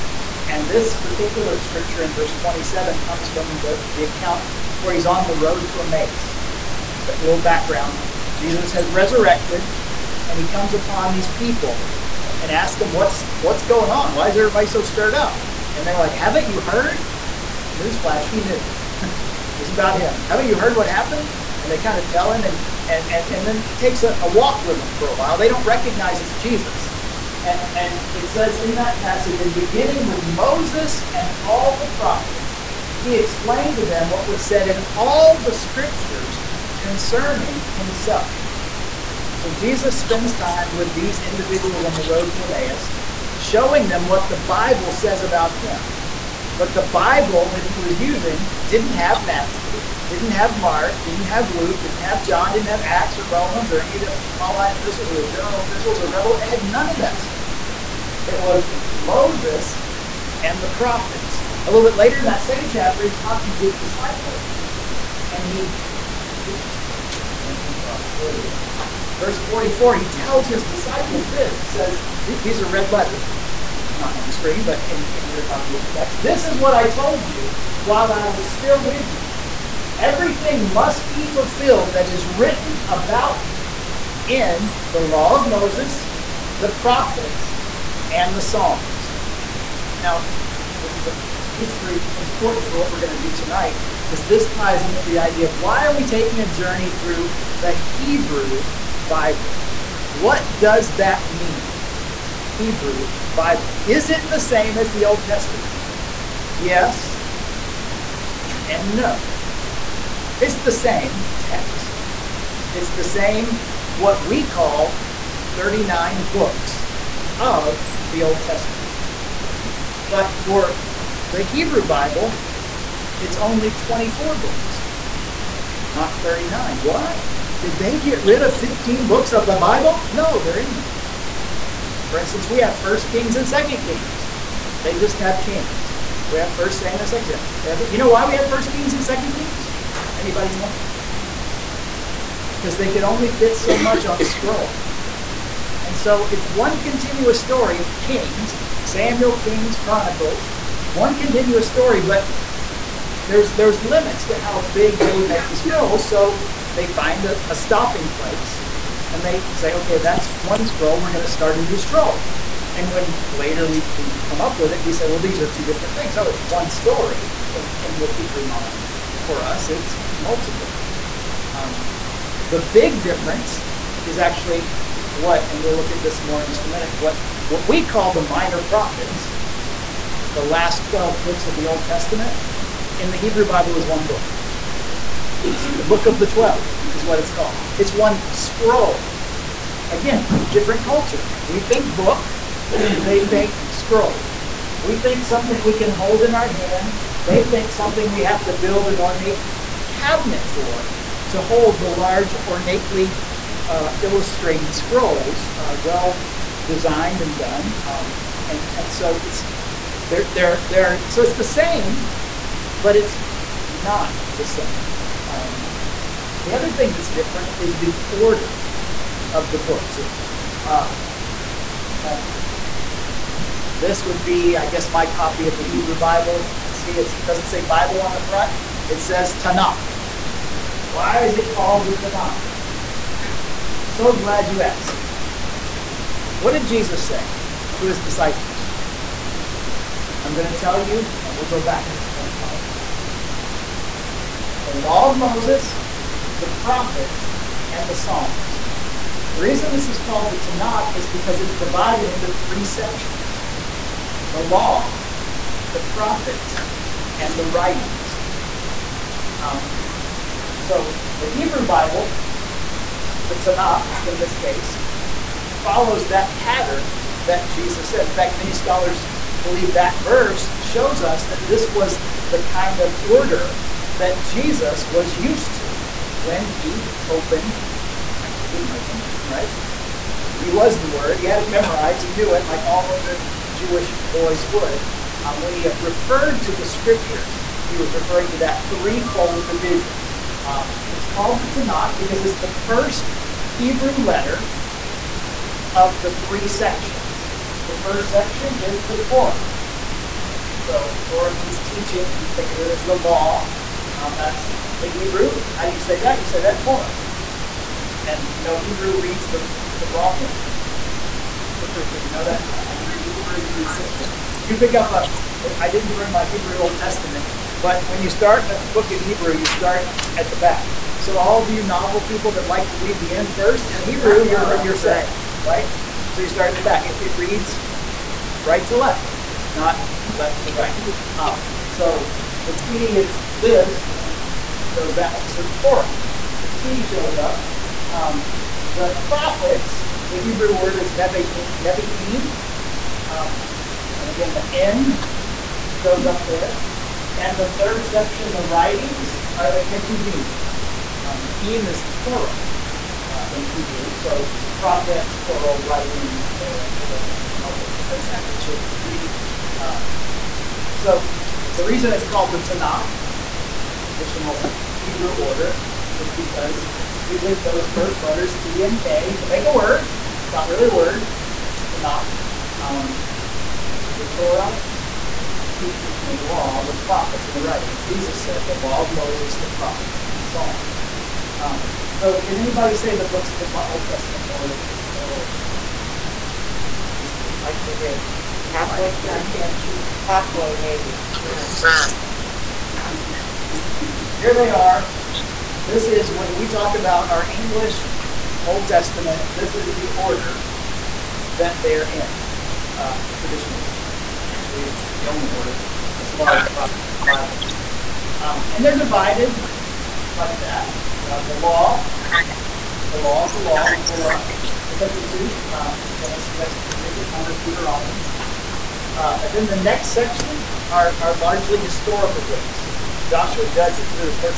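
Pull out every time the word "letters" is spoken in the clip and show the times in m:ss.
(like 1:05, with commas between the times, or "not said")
1:12, 4:54, 6:08.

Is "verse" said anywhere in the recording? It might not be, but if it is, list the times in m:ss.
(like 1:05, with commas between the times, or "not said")
0:02, 1:09, 4:30.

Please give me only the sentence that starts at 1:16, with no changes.
This is what I told you while I was still with you.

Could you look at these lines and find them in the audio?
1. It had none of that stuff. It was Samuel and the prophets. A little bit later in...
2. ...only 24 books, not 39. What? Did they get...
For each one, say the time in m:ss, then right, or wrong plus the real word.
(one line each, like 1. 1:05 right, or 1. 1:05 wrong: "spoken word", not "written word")
1. 0:56 wrong: "Moses", not "Samuel"
2. 2:03 right.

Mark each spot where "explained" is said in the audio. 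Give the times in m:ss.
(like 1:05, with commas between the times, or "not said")
0:33.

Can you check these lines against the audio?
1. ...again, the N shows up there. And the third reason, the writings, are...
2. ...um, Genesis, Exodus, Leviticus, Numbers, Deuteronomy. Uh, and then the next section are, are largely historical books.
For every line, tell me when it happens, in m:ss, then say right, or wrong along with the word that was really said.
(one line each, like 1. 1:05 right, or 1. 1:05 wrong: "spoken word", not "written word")
1. 5:44 wrong: "section", not "reason"
2. 6:55 right.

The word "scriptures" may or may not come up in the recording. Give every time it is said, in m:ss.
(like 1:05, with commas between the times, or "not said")
0:01, 0:35, 4:46.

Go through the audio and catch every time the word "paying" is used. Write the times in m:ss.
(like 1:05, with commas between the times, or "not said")
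not said.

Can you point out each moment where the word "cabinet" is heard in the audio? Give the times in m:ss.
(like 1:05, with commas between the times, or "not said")
3:19.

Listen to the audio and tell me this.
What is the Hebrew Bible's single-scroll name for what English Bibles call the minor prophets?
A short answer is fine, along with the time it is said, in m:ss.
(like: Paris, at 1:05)
The book of the 12, at 3:05.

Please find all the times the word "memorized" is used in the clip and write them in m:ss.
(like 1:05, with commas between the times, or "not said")
4:41.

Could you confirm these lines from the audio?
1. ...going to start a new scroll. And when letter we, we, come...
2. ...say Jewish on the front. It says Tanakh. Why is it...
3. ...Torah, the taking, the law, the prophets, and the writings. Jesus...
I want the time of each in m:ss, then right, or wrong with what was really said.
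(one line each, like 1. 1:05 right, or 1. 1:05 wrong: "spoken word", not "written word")
1. 2:41 wrong: "later", not "letter"
2. 3:47 wrong: "Bible", not "Jewish"
3. 6:14 wrong: "teaching", not "taking".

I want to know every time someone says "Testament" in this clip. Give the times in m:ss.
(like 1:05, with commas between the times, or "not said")
1:45, 1:58, 3:01, 5:16, 6:23, 6:38.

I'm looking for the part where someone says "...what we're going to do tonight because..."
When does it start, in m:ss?
1:32.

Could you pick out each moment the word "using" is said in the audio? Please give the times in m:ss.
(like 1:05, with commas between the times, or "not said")
0:47, 6:07.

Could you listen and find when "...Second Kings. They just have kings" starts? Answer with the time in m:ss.
2:13.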